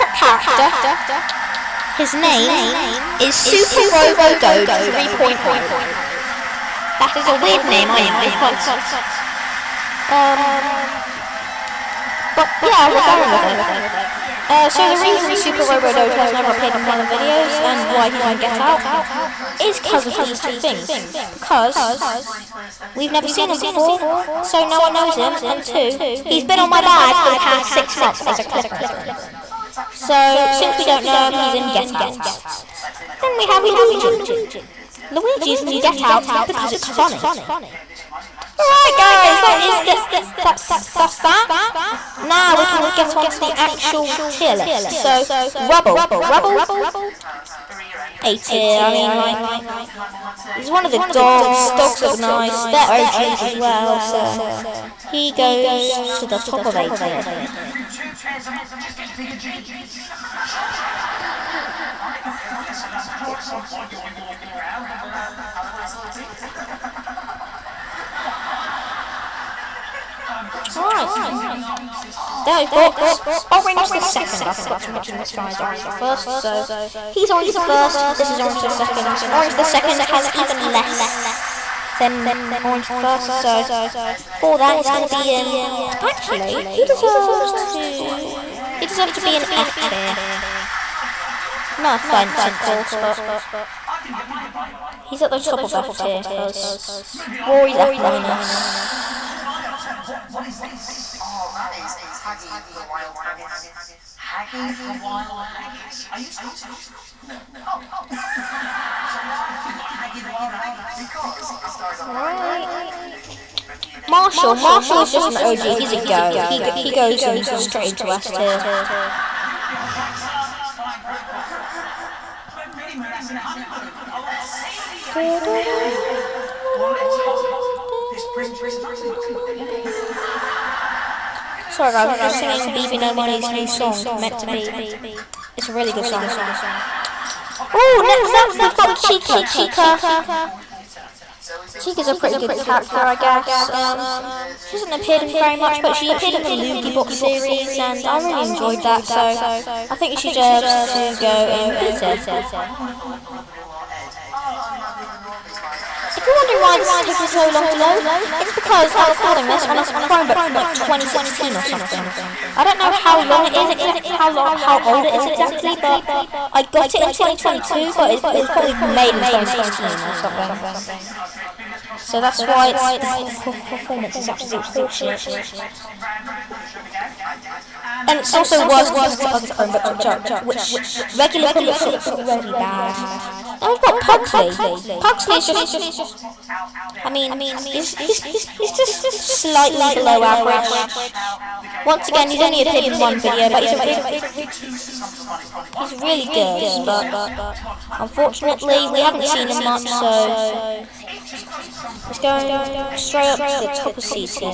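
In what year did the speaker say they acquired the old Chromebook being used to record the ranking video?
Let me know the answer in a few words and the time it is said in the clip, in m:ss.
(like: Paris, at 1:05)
2022, at 2:47.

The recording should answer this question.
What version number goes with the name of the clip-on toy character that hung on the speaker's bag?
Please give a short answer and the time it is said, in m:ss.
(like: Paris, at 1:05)
3.0, at 0:04.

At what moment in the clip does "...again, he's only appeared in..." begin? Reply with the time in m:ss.
3:12.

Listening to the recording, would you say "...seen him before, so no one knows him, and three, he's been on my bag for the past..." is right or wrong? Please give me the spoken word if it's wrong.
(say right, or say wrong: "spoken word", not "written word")
wrong: "two", not "three".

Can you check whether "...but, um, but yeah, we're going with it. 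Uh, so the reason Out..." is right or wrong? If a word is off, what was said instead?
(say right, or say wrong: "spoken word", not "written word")
wrong: "Super", not "Out".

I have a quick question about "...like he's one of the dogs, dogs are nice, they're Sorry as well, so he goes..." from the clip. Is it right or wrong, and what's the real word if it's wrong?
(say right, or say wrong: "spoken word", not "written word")
wrong: "OGs", not "Sorry".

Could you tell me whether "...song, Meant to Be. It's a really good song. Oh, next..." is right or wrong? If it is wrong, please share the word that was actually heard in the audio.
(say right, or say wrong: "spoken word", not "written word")
right.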